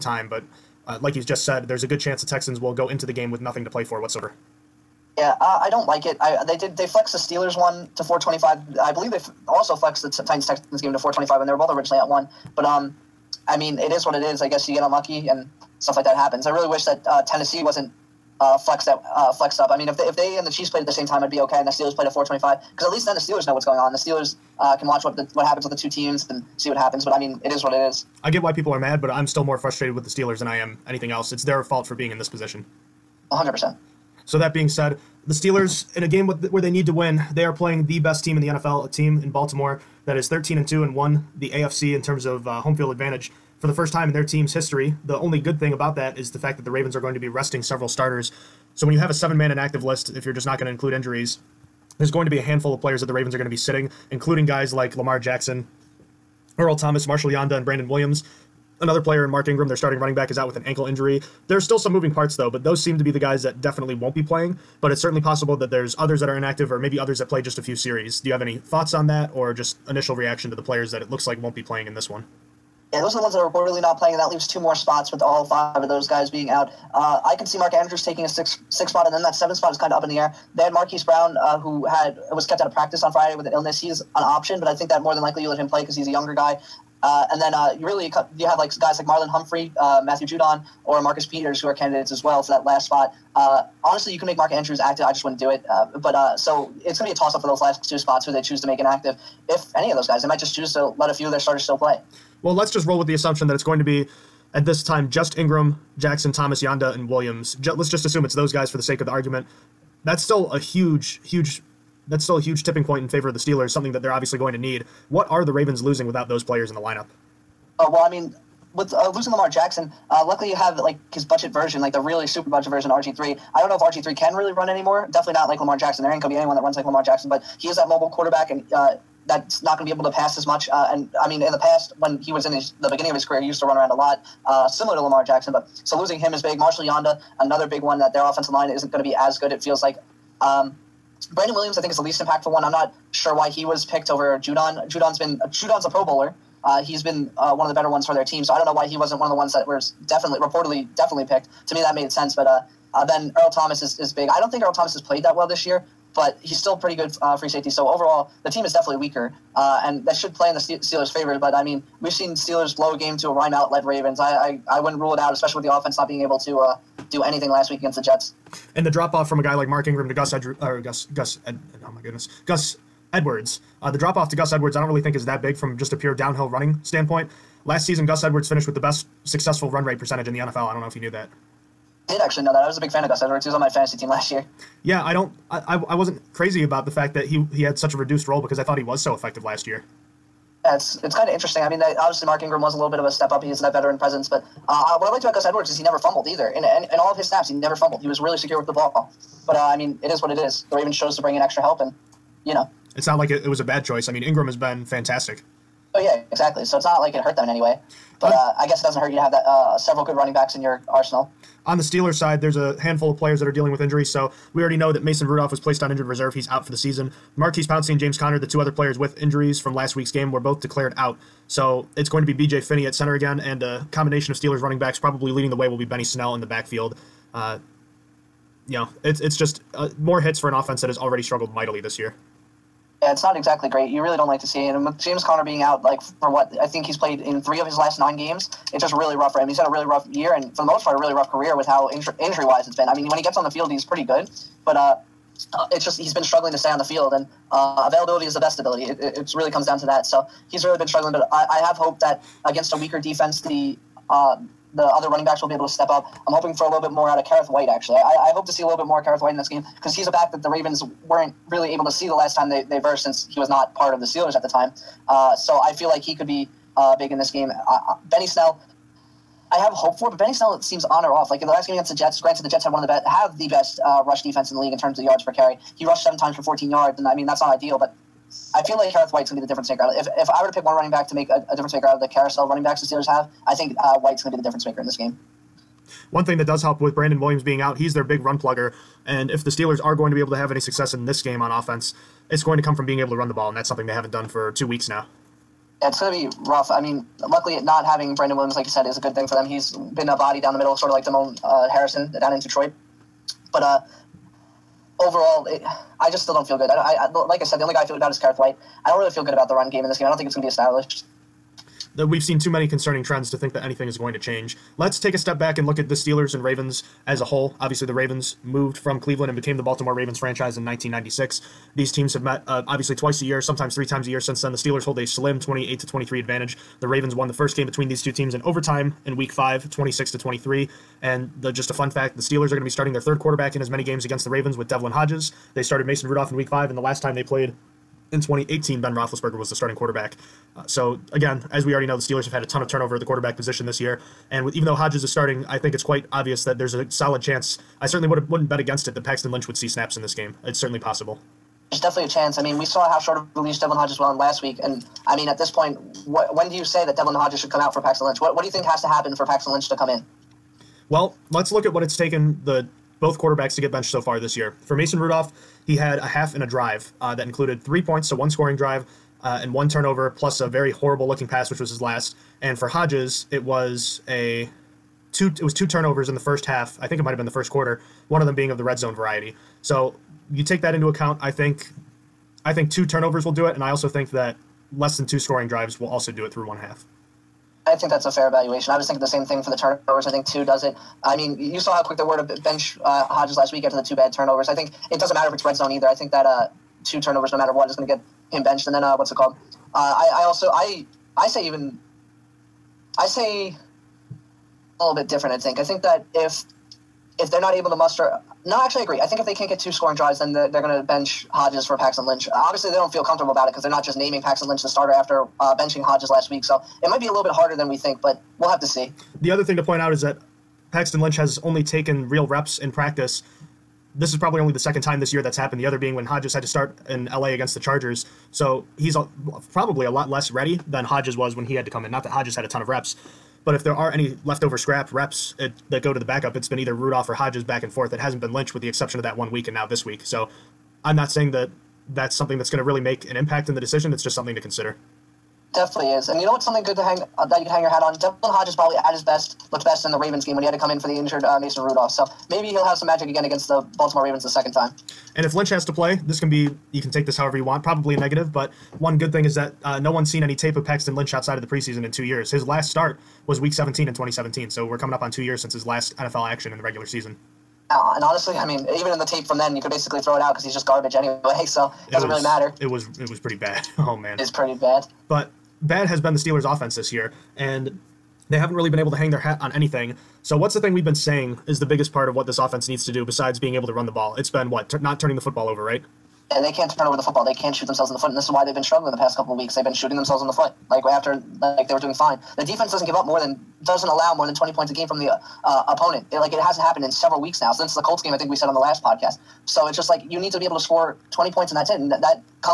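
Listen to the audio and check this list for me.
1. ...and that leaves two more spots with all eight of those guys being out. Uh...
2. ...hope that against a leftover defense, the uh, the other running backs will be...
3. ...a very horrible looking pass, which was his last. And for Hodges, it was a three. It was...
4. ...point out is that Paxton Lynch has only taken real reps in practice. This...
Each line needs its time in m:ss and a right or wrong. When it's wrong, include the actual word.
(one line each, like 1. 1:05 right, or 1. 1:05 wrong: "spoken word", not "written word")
1. 1:14 wrong: "five", not "eight"
2. 4:11 wrong: "weaker", not "leftover"
3. 6:10 wrong: "two", not "three"
4. 6:59 right.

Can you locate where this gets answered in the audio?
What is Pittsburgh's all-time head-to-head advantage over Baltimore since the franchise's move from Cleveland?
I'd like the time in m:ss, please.
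5:25.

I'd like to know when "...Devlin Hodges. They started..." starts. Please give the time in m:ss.
5:34.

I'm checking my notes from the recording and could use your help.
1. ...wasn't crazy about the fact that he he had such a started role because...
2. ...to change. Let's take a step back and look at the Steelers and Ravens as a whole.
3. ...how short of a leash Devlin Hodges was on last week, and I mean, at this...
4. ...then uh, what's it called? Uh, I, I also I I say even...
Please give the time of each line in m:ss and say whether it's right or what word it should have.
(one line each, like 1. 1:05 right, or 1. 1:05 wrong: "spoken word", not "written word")
1. 3:05 wrong: "reduced", not "started"
2. 5:14 right
3. 5:52 right
4. 6:38 right.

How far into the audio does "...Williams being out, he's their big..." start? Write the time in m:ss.
4:47.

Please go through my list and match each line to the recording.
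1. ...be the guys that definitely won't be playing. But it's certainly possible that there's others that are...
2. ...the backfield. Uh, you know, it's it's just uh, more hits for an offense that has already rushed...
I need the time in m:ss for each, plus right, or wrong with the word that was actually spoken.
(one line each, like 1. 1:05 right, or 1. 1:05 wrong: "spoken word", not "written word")
1. 1:03 right
2. 3:46 wrong: "struggled", not "rushed".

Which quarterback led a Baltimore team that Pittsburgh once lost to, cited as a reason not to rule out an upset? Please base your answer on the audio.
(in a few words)
Ryan Mallett.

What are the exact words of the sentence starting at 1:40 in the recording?
They might just choose to let a few of their starters still play.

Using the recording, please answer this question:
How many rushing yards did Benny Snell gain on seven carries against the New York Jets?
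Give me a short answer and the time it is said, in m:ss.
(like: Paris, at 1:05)
14, at 4:36.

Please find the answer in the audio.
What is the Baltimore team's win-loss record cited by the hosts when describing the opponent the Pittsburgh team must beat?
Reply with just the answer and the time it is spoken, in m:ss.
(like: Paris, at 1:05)
13 and 2, at 0:40.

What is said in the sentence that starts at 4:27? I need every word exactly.
Uh, uh, Benny Snell, I have hope for, but Benny Snell seems on or off.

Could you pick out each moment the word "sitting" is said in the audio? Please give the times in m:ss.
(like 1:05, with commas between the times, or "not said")
0:53.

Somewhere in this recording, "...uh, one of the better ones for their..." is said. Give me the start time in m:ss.
2:27.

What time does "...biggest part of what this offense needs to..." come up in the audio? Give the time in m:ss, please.
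8:01.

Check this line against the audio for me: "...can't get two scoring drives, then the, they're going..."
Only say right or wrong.
right.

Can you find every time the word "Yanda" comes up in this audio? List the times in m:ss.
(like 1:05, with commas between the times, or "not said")
0:57, 1:46, 2:16.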